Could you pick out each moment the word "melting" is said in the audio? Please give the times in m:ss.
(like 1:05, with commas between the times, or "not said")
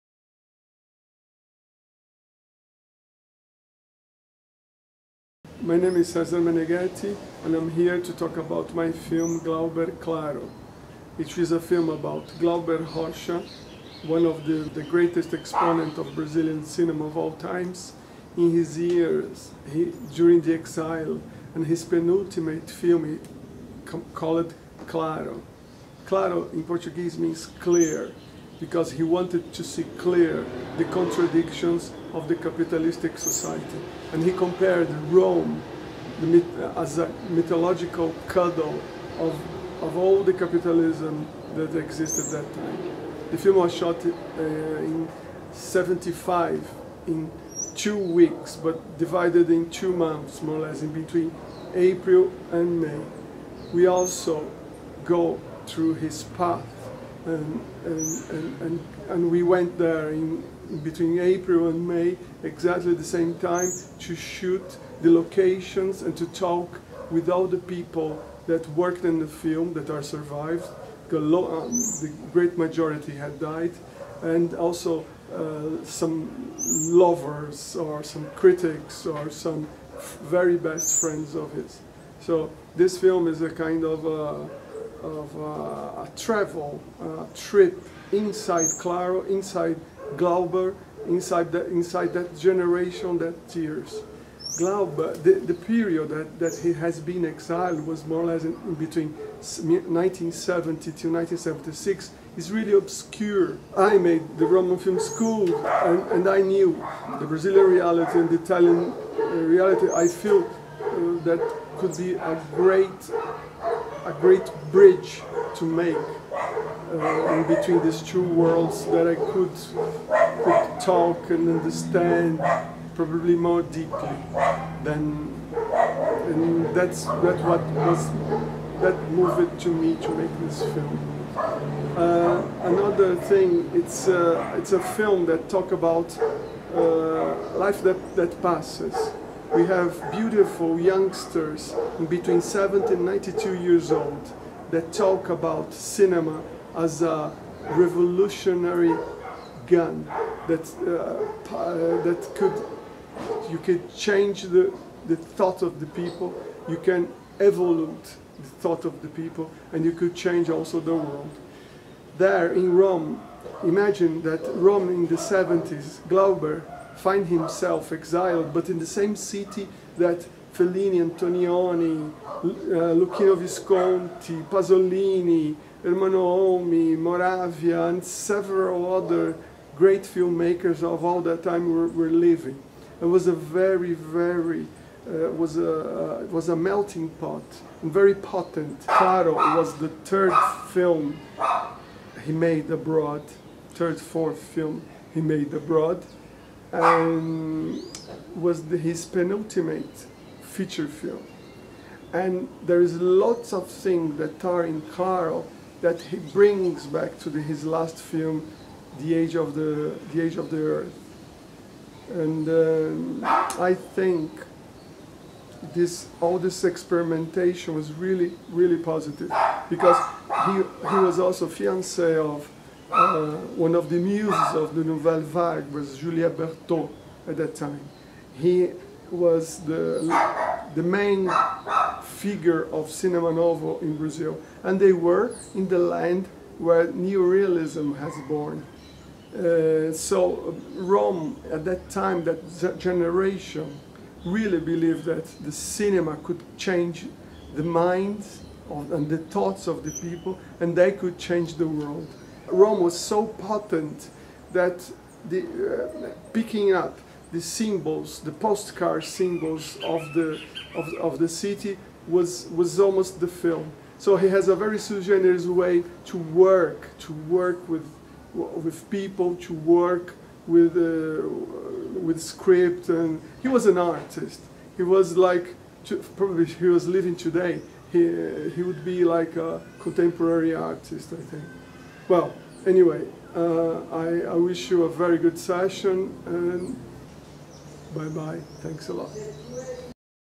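3:06.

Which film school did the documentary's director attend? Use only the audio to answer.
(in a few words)
Roman Film School.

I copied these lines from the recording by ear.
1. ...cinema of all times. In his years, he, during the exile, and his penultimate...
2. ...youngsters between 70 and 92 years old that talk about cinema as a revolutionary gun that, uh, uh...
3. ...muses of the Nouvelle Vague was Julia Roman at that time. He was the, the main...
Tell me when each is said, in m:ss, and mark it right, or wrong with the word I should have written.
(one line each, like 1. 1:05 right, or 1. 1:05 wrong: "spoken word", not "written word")
1. 0:16 right
2. 2:20 right
3. 3:43 wrong: "Berto", not "Roman".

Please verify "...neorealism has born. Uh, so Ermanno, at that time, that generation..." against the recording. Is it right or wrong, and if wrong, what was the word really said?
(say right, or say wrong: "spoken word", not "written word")
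wrong: "Rome", not "Ermanno".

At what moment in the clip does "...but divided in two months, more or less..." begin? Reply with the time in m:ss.
0:48.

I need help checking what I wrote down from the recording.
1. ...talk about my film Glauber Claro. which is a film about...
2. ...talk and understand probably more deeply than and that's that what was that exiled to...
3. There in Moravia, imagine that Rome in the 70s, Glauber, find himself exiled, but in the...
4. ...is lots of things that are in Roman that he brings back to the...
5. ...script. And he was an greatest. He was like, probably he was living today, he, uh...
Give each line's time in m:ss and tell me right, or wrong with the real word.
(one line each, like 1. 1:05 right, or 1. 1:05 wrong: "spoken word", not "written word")
1. 0:08 right
2. 2:00 wrong: "moved", not "exiled"
3. 2:42 wrong: "Rome", not "Moravia"
4. 3:22 wrong: "Claro", not "Roman"
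5. 4:32 wrong: "artist", not "greatest".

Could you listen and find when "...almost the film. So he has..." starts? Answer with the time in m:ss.
4:22.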